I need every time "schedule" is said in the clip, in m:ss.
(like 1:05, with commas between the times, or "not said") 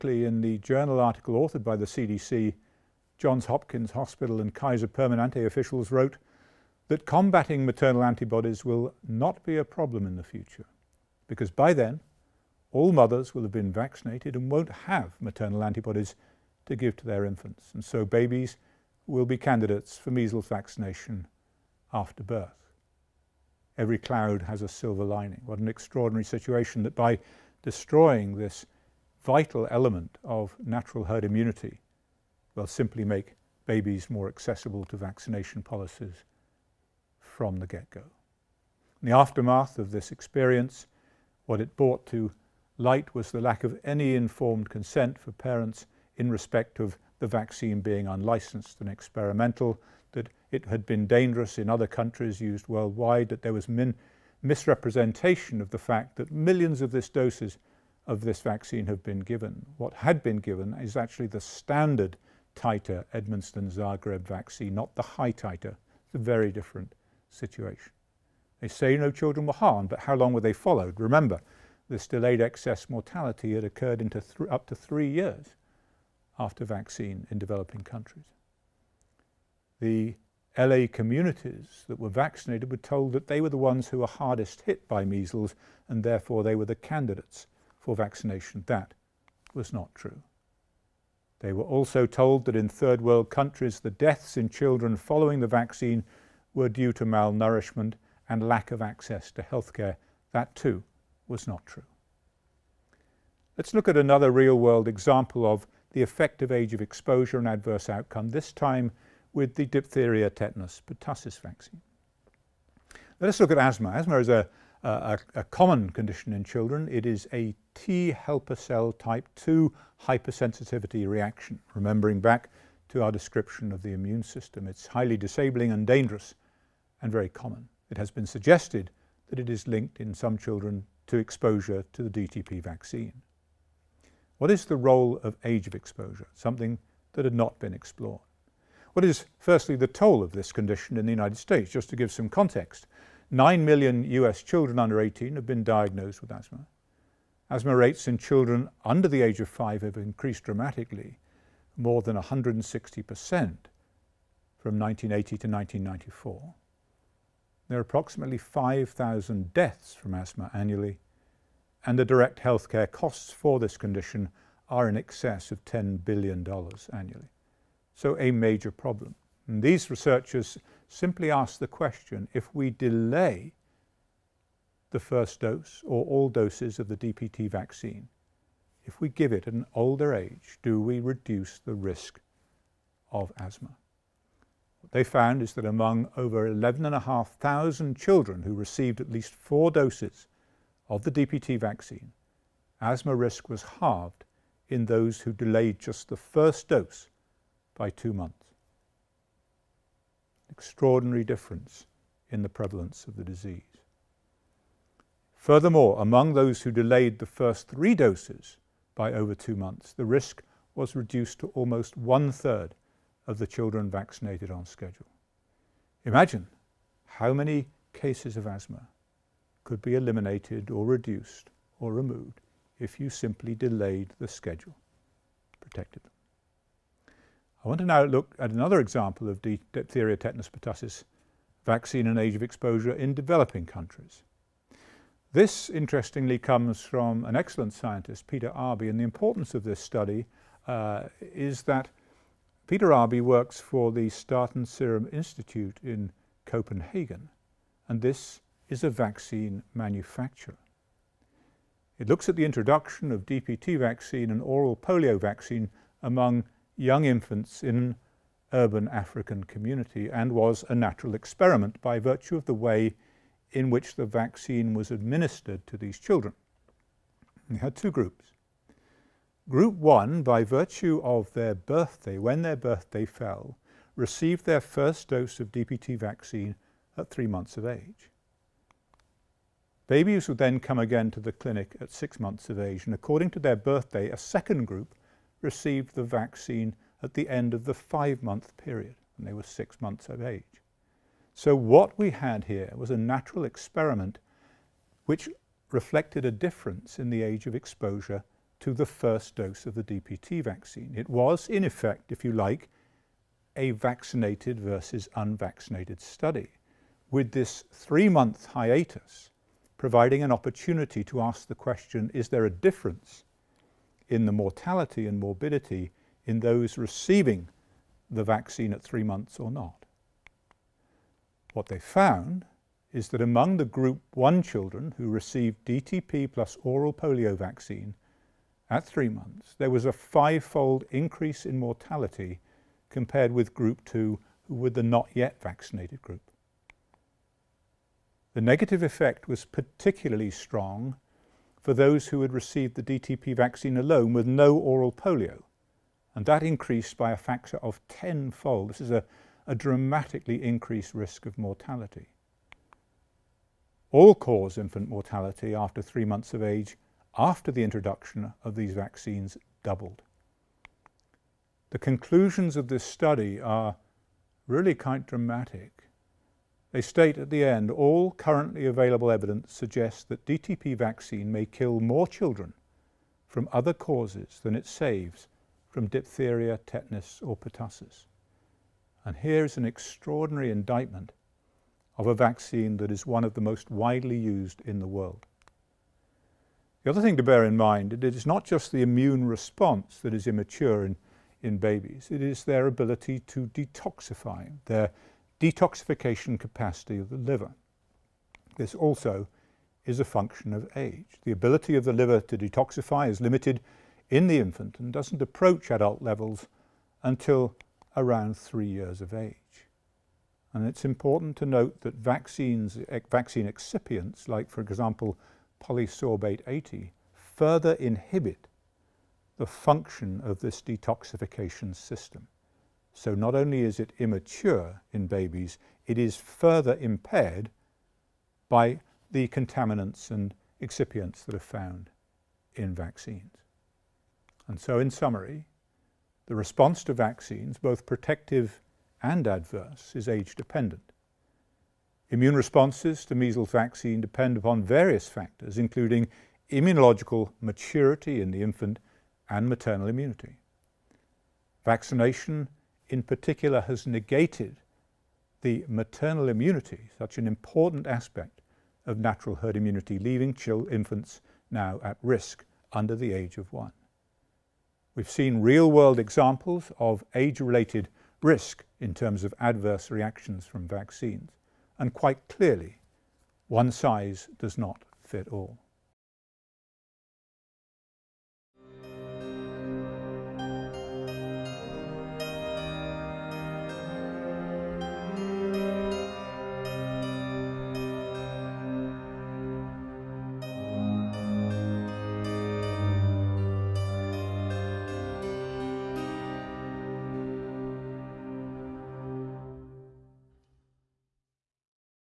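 3:34, 3:44.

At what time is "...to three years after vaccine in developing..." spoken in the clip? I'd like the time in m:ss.
1:14.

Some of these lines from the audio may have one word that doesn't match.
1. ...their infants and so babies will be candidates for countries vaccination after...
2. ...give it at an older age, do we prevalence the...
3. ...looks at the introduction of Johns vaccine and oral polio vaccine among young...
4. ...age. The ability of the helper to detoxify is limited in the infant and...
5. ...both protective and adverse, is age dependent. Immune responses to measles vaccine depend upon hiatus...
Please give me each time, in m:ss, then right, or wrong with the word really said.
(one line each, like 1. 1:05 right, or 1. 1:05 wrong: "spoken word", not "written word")
1. 0:17 wrong: "measles", not "countries"
2. 2:59 wrong: "reduce", not "prevalence"
3. 4:12 wrong: "DPT", not "Johns"
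4. 6:40 wrong: "liver", not "helper"
5. 7:17 wrong: "various", not "hiatus".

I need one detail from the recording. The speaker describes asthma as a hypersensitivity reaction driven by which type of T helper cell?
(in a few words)
Type 2.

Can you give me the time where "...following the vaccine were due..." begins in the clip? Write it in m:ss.
1:34.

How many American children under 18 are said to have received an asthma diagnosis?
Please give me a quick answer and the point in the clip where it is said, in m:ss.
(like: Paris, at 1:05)
9 million, at 2:23.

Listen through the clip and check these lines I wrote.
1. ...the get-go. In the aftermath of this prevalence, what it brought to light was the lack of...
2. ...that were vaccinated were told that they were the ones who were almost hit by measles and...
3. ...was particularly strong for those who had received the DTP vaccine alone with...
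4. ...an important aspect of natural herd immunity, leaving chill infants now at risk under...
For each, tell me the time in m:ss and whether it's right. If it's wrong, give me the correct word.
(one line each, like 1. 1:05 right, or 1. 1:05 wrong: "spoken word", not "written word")
1. 0:37 wrong: "experience", not "prevalence"
2. 1:21 wrong: "hardest", not "almost"
3. 5:39 right
4. 7:37 right.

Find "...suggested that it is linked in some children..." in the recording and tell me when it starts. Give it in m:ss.
2:08.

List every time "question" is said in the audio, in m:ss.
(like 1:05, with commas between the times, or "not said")
2:51, 5:11.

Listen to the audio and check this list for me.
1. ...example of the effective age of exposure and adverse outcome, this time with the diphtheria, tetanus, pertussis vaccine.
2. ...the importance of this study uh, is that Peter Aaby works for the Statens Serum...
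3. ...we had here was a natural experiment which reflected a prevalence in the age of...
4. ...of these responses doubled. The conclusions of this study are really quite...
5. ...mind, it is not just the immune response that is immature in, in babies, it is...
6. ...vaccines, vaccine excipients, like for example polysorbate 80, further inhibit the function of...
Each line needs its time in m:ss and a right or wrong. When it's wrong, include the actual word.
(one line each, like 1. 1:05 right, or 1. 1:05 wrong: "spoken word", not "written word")
1. 1:44 right
2. 3:58 right
3. 4:51 wrong: "difference", not "prevalence"
4. 5:58 wrong: "vaccines", not "responses"
5. 6:27 right
6. 6:51 right.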